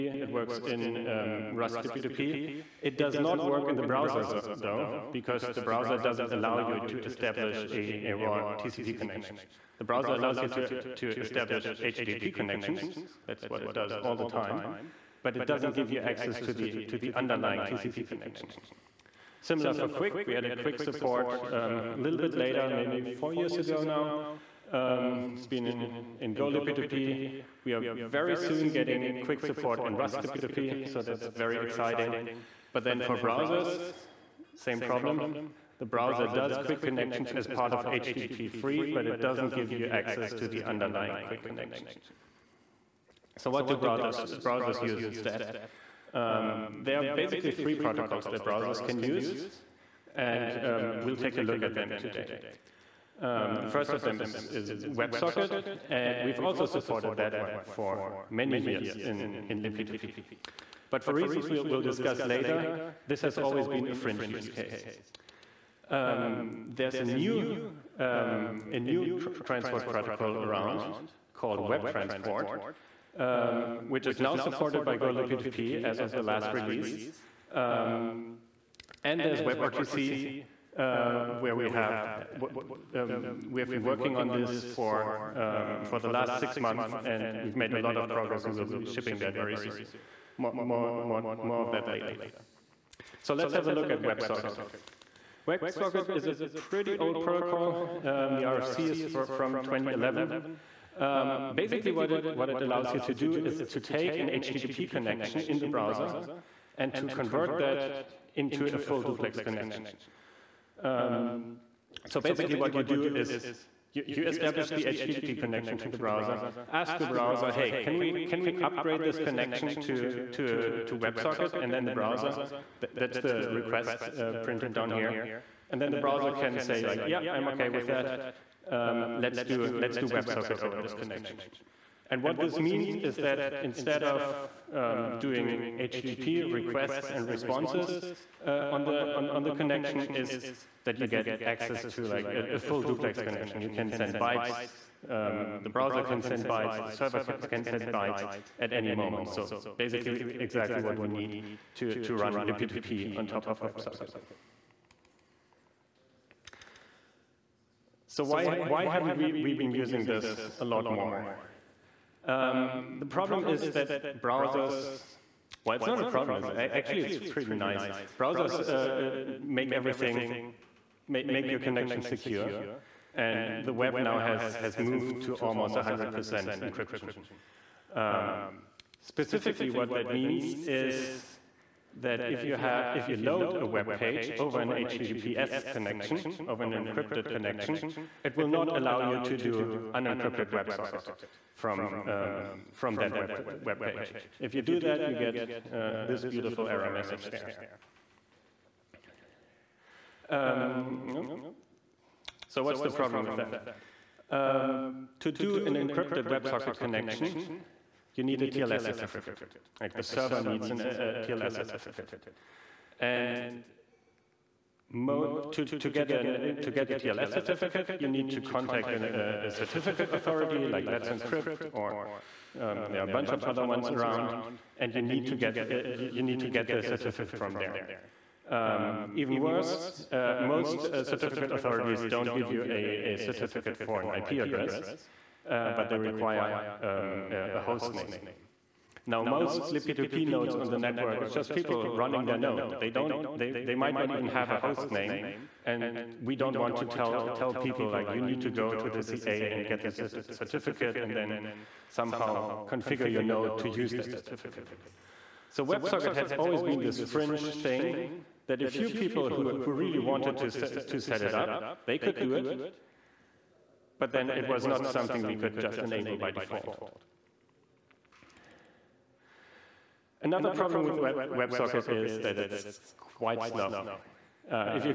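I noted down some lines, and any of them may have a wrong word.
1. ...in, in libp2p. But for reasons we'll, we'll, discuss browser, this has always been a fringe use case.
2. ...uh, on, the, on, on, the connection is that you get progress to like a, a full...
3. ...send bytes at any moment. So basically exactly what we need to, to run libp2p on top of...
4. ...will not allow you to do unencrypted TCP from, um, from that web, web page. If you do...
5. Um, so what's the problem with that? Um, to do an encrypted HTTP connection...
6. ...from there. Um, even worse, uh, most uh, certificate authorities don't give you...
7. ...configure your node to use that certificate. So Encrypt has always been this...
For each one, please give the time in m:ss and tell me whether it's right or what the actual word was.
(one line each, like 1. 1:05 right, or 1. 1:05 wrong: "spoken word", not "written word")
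1. 0:59 wrong: "later", not "browser"
2. 2:18 wrong: "access", not "progress"
3. 2:27 right
4. 3:08 wrong: "WebSocket", not "TCP"
5. 3:20 wrong: "WebSocket", not "HTTP"
6. 3:47 right
7. 4:12 wrong: "WebSocket", not "Encrypt".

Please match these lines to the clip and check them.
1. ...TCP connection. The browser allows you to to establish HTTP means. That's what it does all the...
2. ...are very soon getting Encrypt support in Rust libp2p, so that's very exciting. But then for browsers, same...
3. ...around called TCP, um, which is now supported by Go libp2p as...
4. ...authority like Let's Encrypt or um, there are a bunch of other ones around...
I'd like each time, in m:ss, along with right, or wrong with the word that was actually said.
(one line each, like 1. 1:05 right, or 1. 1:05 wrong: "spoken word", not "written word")
1. 0:08 wrong: "connections", not "means"
2. 0:27 wrong: "QUIC", not "Encrypt"
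3. 1:10 wrong: "WebTransport", not "TCP"
4. 3:40 right.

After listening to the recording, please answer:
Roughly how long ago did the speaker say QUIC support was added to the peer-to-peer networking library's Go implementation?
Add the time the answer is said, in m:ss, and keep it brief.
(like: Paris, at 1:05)
4 years, at 0:23.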